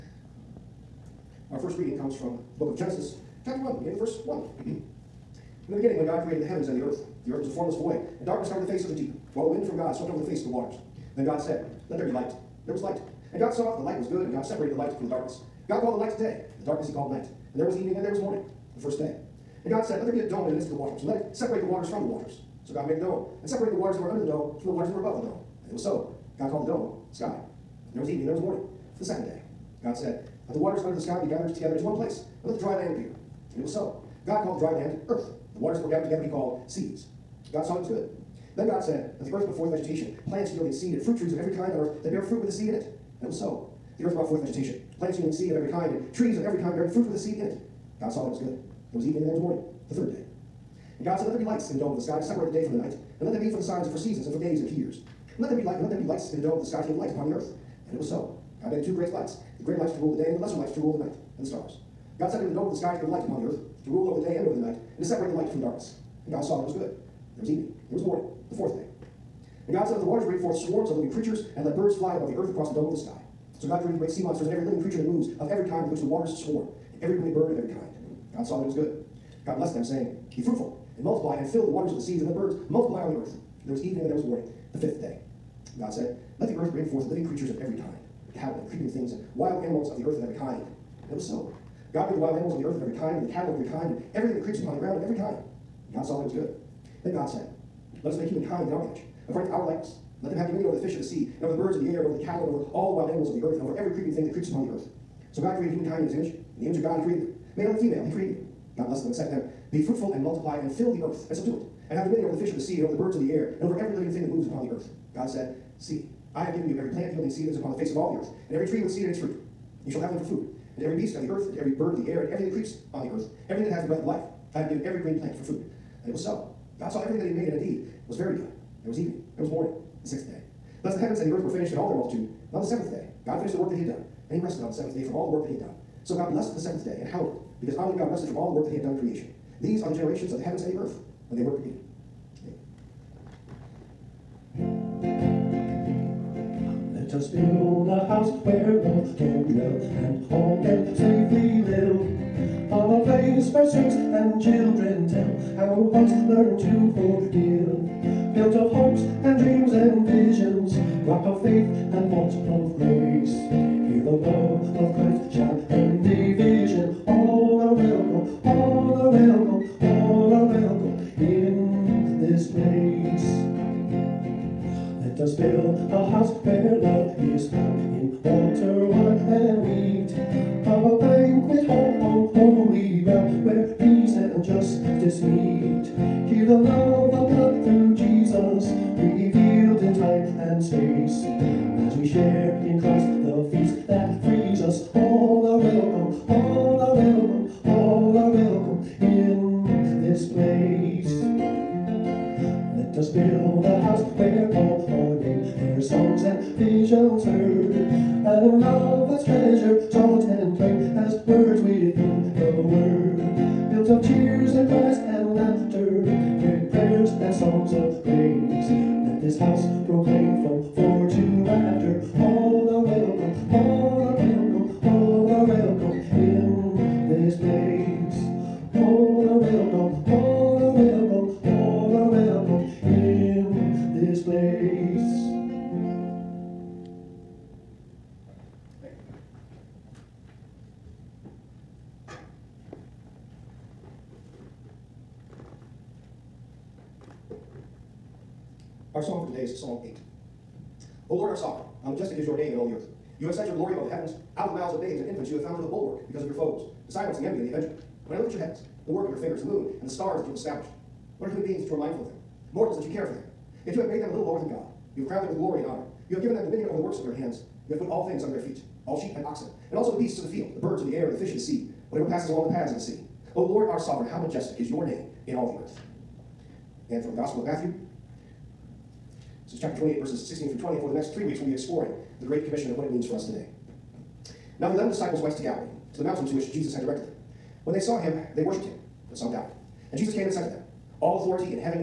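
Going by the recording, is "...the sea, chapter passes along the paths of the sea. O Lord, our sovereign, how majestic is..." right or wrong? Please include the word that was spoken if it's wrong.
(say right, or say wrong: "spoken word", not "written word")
wrong: "whatever", not "chapter".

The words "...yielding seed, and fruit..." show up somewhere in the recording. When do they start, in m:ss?
0:40.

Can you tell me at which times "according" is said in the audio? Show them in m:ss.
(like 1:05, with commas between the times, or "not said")
1:39.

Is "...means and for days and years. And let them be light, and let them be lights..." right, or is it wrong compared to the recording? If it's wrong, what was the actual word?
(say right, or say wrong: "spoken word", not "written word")
wrong: "seasons", not "means".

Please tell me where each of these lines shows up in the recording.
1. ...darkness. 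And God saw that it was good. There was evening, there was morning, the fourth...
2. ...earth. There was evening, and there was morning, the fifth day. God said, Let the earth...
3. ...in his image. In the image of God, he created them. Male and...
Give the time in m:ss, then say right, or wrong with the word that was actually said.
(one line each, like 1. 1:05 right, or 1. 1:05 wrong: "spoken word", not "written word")
1. 1:05 right
2. 1:23 right
3. 1:46 right.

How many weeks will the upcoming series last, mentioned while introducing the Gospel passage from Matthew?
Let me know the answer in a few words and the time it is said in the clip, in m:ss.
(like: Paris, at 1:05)
3, at 4:41.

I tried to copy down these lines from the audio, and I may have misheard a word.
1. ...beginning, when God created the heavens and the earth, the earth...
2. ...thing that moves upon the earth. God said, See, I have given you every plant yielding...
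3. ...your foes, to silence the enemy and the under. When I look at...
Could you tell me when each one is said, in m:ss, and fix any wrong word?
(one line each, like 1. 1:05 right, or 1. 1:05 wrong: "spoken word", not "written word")
1. 0:05 right
2. 1:54 right
3. 4:16 wrong: "avenger", not "under".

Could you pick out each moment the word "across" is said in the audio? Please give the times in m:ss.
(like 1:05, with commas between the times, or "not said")
1:12.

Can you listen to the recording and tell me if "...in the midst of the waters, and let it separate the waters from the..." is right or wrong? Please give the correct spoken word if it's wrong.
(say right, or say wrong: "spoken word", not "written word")
right.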